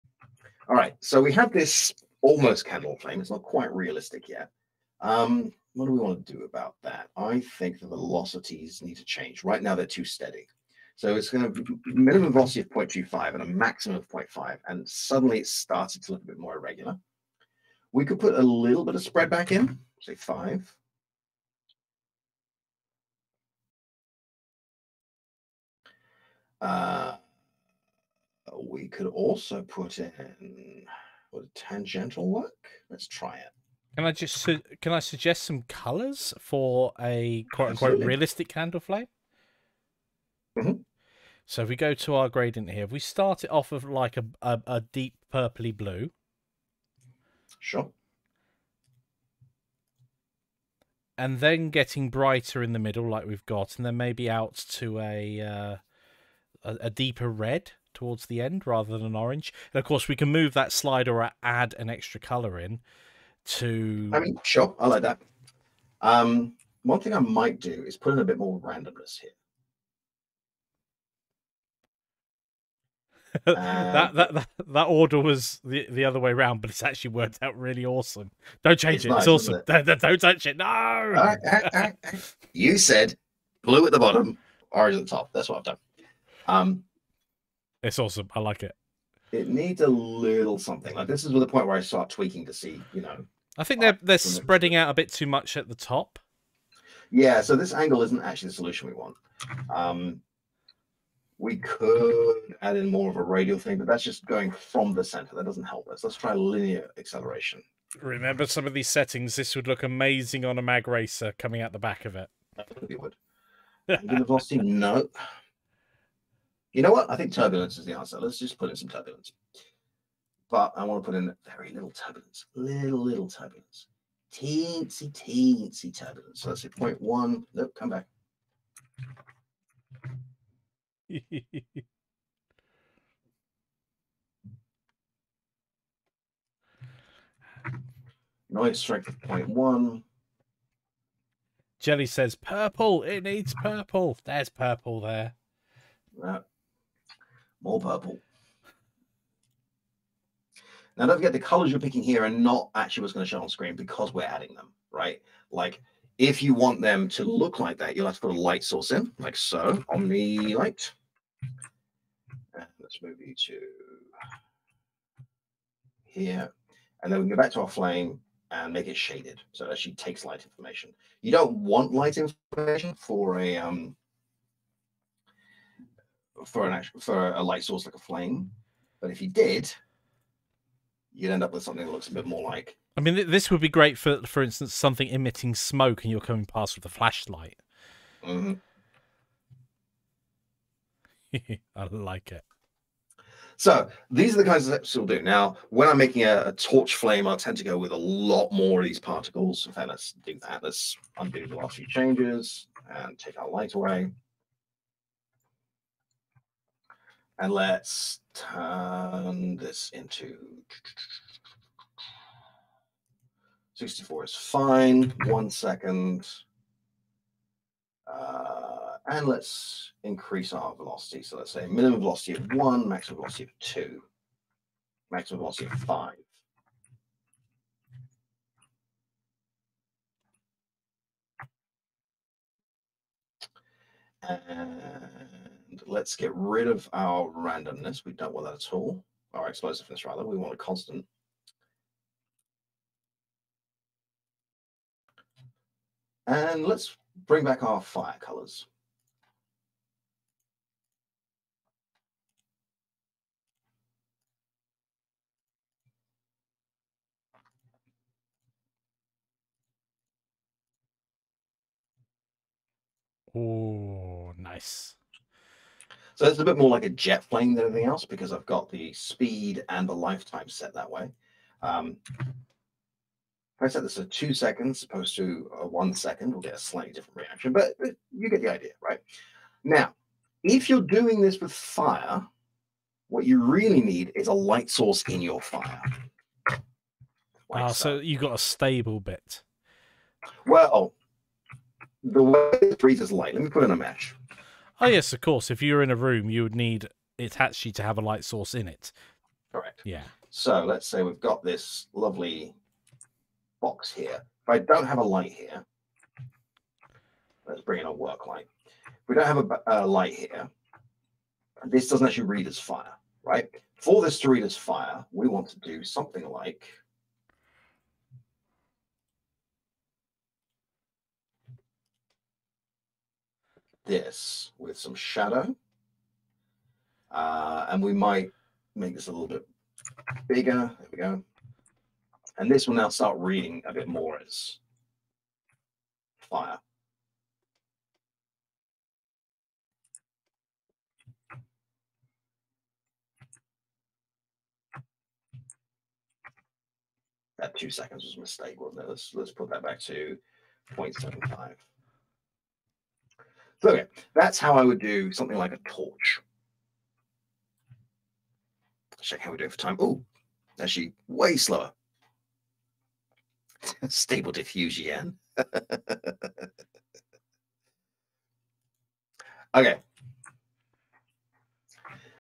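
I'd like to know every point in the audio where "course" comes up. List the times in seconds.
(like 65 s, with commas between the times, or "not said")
59 s, 295 s.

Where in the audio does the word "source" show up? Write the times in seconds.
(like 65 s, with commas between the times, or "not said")
158 s, 177 s, 284 s, 298 s.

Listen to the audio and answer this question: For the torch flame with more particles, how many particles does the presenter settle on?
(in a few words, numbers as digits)
64.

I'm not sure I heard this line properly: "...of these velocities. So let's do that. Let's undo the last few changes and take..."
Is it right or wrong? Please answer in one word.
wrong.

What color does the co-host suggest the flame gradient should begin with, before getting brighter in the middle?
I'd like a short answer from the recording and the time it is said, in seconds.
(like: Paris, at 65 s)
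deep purpley blue, at 44 s.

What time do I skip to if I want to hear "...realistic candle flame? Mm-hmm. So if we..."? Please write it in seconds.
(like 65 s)
37 s.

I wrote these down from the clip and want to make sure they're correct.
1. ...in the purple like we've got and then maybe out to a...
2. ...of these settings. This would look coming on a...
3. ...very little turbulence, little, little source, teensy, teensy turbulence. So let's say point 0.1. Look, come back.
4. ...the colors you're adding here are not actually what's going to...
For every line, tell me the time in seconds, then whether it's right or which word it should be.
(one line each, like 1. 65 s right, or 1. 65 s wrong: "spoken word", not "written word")
1. 52 s wrong: "middle", not "purple"
2. 108 s wrong: "amazing", not "coming"
3. 121 s wrong: "turbulence", not "source"
4. 151 s wrong: "picking", not "adding".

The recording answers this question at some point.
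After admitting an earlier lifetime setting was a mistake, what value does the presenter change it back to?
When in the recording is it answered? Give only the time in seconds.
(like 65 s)
350 s.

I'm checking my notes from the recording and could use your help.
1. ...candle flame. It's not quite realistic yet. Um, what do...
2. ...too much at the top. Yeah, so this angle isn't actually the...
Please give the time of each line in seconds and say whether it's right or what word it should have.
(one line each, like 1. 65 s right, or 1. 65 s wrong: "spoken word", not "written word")
1. 2 s right
2. 95 s right.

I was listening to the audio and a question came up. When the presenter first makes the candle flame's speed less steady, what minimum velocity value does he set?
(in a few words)
0.25.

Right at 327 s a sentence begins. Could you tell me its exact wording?
Uh, and we might make this a little bit bigger.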